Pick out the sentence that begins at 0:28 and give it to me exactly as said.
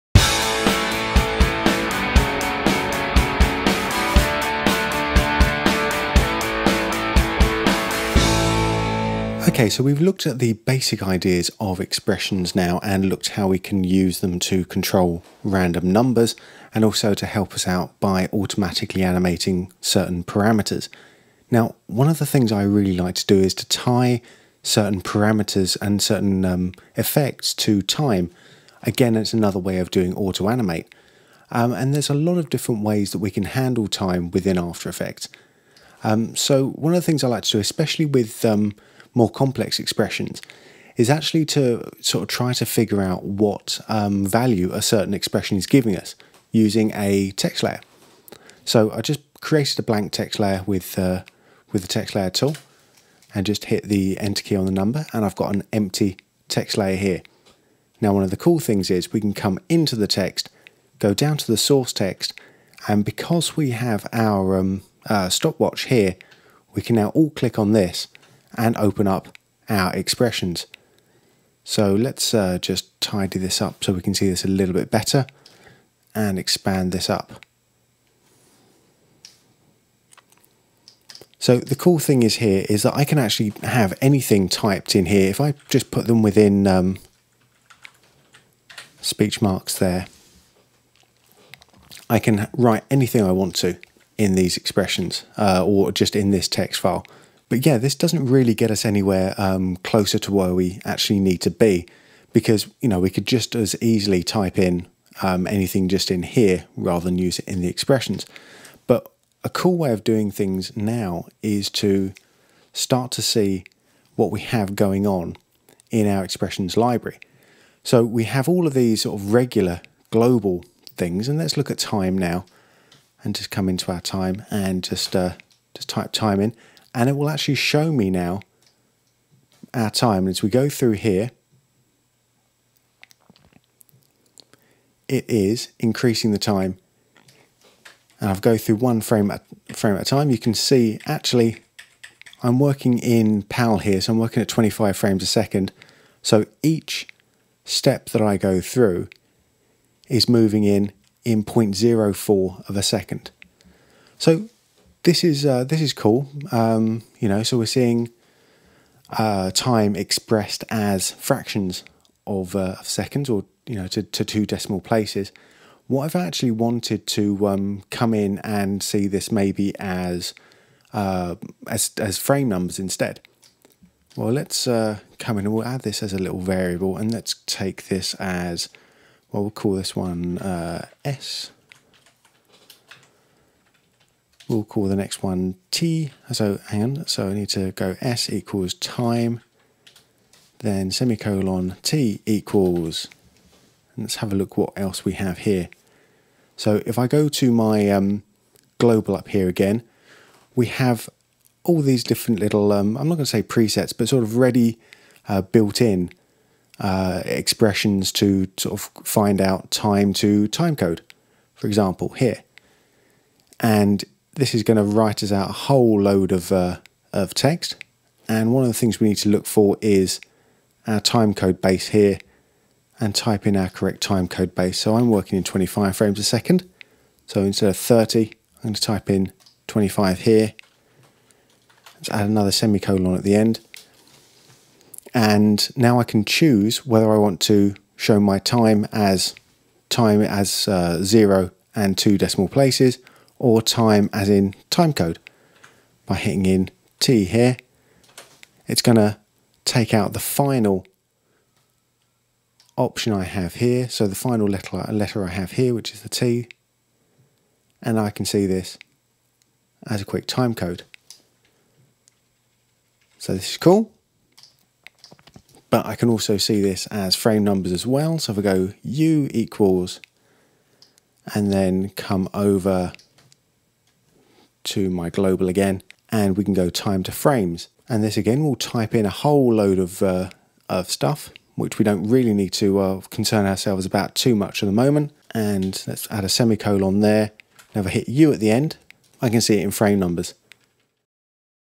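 Again, it's another way of doing auto animate.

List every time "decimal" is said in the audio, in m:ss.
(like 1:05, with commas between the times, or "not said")
2:44, 4:02.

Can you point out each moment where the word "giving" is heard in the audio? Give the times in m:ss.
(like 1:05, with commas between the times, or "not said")
0:45.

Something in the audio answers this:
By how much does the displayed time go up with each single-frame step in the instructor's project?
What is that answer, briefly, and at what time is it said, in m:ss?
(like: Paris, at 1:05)
0.04 of a second, at 2:31.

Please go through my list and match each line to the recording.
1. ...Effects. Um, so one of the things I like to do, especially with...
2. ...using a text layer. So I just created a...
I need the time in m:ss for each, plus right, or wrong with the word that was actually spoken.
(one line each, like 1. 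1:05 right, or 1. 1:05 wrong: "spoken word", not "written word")
1. 0:34 right
2. 0:46 right.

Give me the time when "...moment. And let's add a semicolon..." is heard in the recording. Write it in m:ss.
4:44.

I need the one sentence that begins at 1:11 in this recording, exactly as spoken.
So let's uh, just tidy this up so we can see this a little bit better and expand this up.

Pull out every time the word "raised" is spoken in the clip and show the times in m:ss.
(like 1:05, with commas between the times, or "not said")
not said.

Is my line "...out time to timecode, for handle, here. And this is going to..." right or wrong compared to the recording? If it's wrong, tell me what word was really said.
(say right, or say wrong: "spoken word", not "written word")
wrong: "example", not "handle".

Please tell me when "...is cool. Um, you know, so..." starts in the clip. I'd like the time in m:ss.
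2:35.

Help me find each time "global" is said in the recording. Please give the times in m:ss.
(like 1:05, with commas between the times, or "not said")
2:00, 3:18, 4:35.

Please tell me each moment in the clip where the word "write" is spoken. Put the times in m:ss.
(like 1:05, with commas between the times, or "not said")
1:32, 3:34.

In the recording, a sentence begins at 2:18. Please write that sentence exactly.
And I've go through one frame at, frame at a time.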